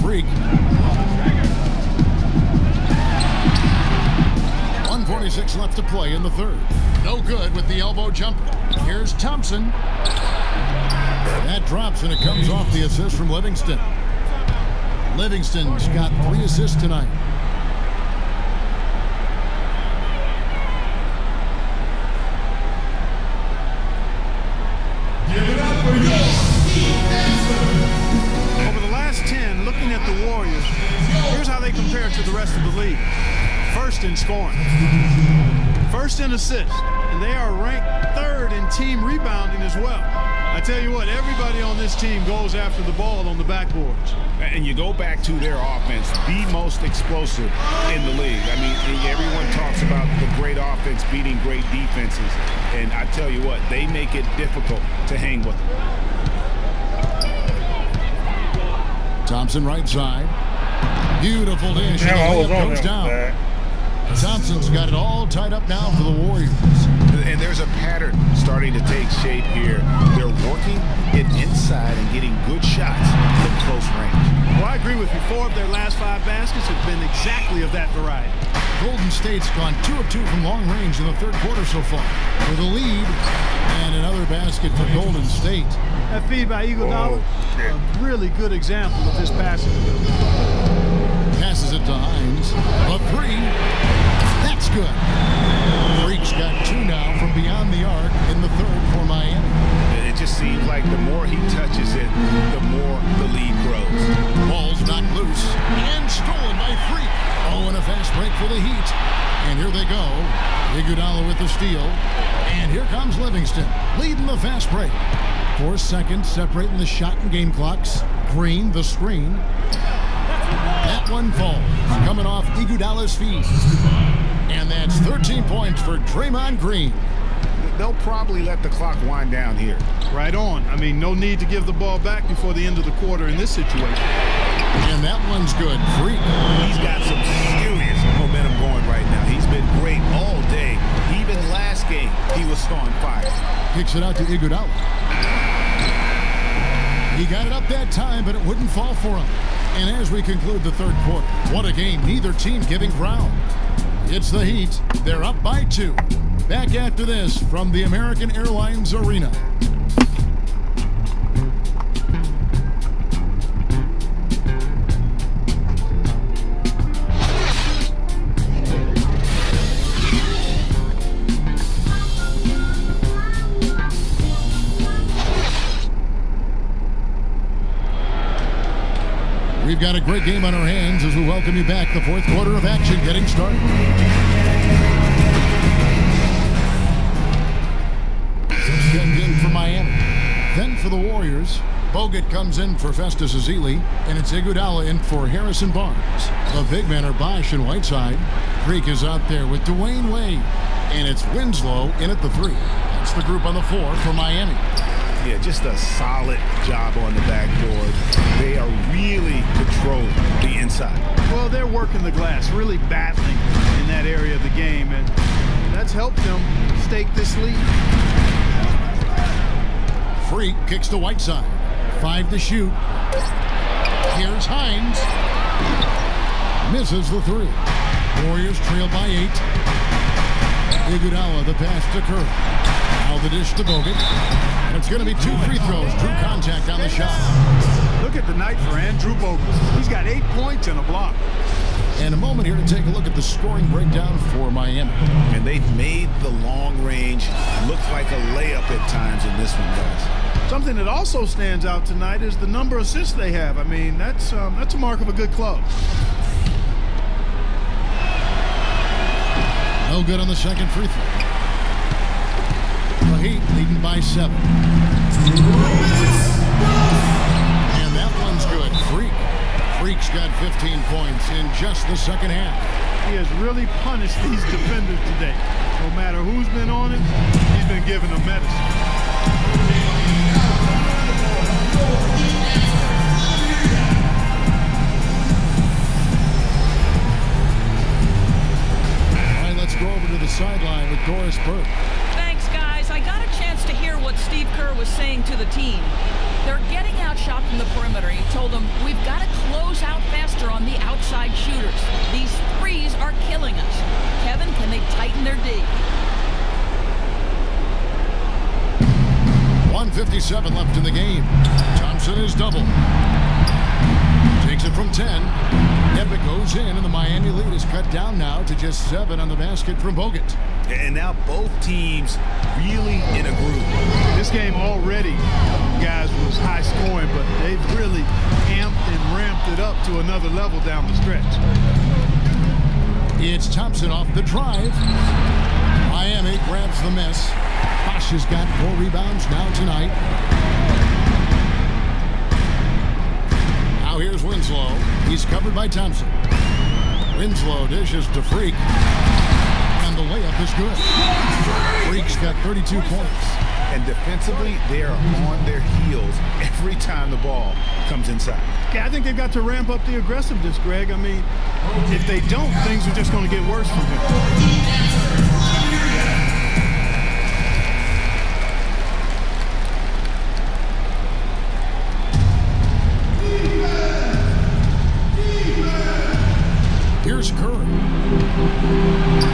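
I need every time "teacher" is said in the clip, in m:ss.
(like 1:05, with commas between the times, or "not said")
not said.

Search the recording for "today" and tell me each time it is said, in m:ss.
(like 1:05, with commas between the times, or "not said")
4:35.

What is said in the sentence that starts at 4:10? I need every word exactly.
Something that also stands out tonight is the number of assists they have.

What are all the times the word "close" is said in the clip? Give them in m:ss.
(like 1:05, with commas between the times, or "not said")
1:13, 4:59.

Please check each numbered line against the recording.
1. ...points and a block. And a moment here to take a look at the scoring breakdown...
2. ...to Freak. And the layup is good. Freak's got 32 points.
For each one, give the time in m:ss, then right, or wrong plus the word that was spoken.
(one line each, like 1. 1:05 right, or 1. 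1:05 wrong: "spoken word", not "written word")
1. 4:00 right
2. 5:48 right.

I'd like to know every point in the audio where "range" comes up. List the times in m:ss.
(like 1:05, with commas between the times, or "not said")
1:13, 1:20, 4:06.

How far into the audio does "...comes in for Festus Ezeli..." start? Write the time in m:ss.
3:12.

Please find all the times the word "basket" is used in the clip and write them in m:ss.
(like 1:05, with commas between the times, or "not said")
1:16, 1:24, 5:19.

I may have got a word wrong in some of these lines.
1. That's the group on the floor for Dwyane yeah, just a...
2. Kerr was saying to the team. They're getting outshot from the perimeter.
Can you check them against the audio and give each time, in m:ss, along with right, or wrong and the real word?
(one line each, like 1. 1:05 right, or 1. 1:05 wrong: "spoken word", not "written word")
1. 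3:22 wrong: "Miami", not "Dwyane"
2. 4:54 right.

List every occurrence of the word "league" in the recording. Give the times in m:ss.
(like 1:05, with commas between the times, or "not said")
0:32, 0:48.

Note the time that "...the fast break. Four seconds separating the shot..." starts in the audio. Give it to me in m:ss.
1:54.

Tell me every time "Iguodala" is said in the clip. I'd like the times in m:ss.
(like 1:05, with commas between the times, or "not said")
1:26, 1:50, 2:02, 2:24, 3:14, 3:50.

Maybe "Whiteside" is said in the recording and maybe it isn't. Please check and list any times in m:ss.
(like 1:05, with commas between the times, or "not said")
3:17, 3:40.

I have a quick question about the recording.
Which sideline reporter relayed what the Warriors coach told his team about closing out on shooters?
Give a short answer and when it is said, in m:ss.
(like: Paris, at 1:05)
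Doris Burke, at 4:51.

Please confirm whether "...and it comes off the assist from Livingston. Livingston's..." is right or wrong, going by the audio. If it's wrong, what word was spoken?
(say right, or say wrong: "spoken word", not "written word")
right.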